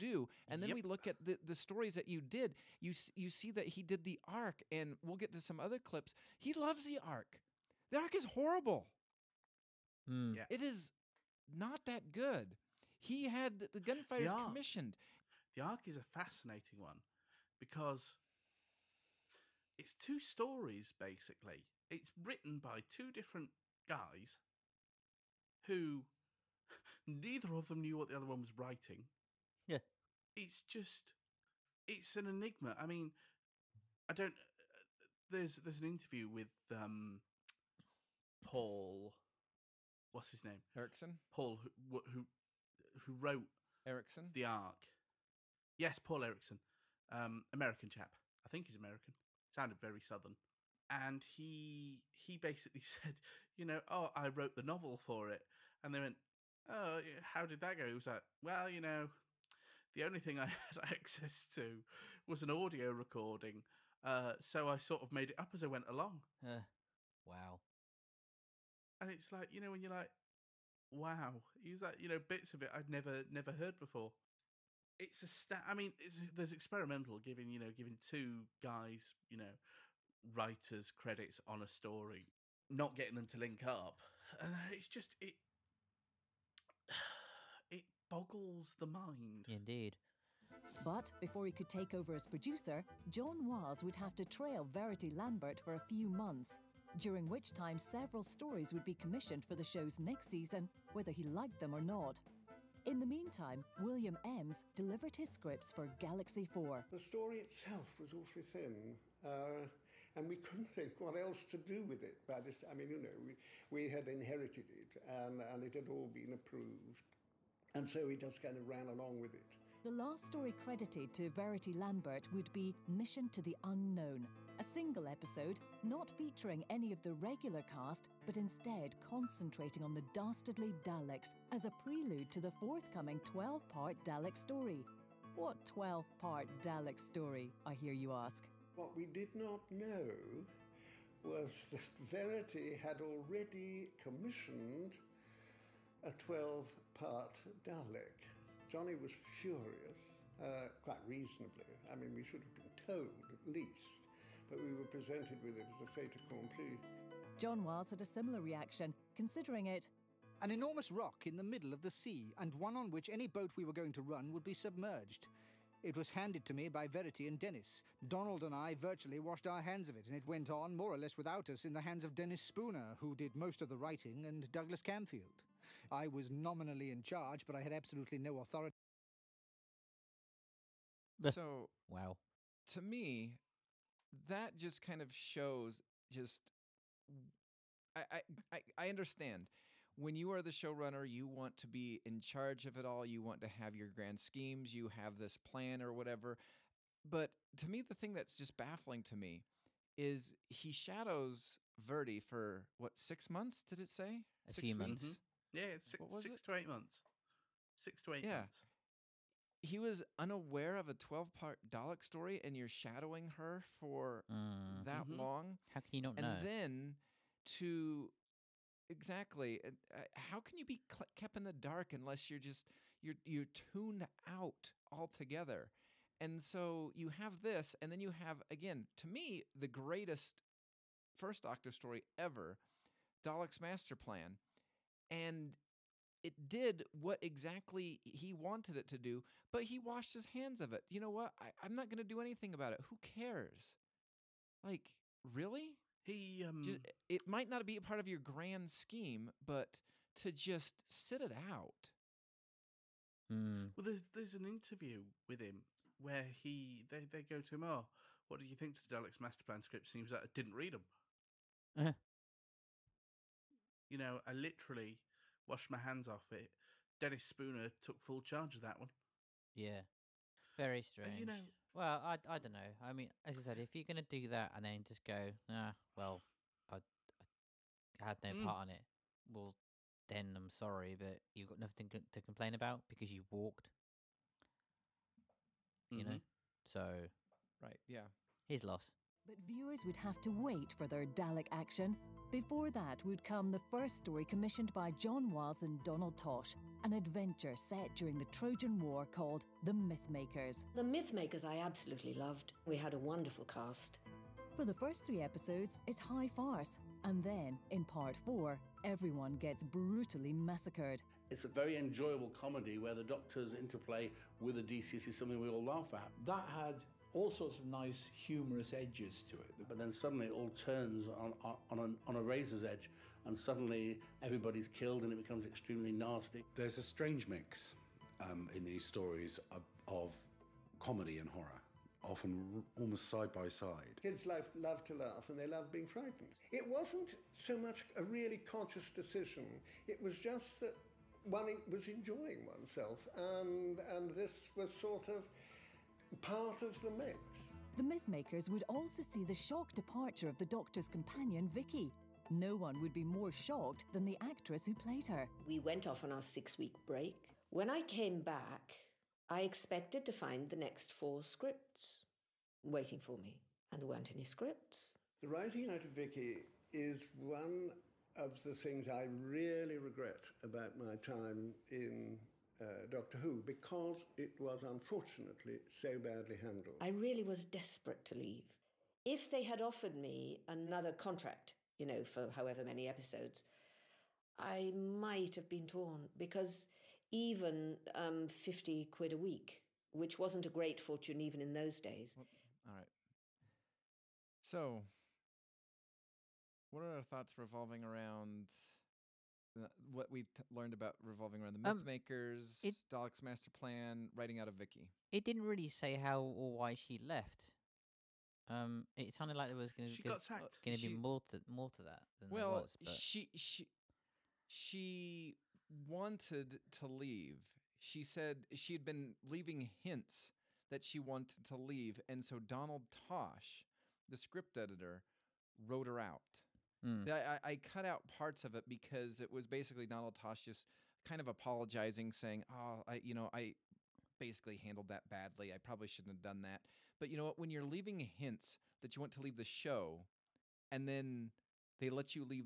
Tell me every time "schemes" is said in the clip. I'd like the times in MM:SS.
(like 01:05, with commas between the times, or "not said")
03:14, 04:08.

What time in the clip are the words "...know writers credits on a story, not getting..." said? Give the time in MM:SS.
01:19.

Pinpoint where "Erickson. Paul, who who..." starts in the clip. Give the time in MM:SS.
00:40.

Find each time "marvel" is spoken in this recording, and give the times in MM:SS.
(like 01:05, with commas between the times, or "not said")
not said.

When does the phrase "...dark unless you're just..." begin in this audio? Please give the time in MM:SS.
03:41.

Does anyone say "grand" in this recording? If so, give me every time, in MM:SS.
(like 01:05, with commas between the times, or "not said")
03:13, 04:08.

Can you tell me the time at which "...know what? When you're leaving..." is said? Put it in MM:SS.
07:17.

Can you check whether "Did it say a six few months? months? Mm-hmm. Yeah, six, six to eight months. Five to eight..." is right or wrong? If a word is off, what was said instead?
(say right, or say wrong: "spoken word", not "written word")
wrong: "Six", not "Five".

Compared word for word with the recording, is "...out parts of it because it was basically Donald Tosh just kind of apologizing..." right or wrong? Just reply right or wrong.
right.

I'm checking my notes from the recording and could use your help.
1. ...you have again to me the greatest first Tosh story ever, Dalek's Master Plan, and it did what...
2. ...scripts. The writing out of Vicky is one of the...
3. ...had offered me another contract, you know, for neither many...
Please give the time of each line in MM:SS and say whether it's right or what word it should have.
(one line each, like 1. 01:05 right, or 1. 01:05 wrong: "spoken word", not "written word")
1. 03:48 wrong: "Doctor", not "Tosh"
2. 06:04 right
3. 06:19 wrong: "however", not "neither".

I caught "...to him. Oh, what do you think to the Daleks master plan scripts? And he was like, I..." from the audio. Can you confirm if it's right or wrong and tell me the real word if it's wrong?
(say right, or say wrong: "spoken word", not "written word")
right.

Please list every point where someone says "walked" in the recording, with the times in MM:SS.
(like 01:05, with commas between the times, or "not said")
04:43.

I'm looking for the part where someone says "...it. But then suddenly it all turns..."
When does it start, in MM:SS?
05:19.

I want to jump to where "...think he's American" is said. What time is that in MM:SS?
00:48.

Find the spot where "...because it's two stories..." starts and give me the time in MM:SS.
00:17.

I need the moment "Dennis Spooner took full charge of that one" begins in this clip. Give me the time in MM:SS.
04:27.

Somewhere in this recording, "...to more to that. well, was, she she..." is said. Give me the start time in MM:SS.
06:51.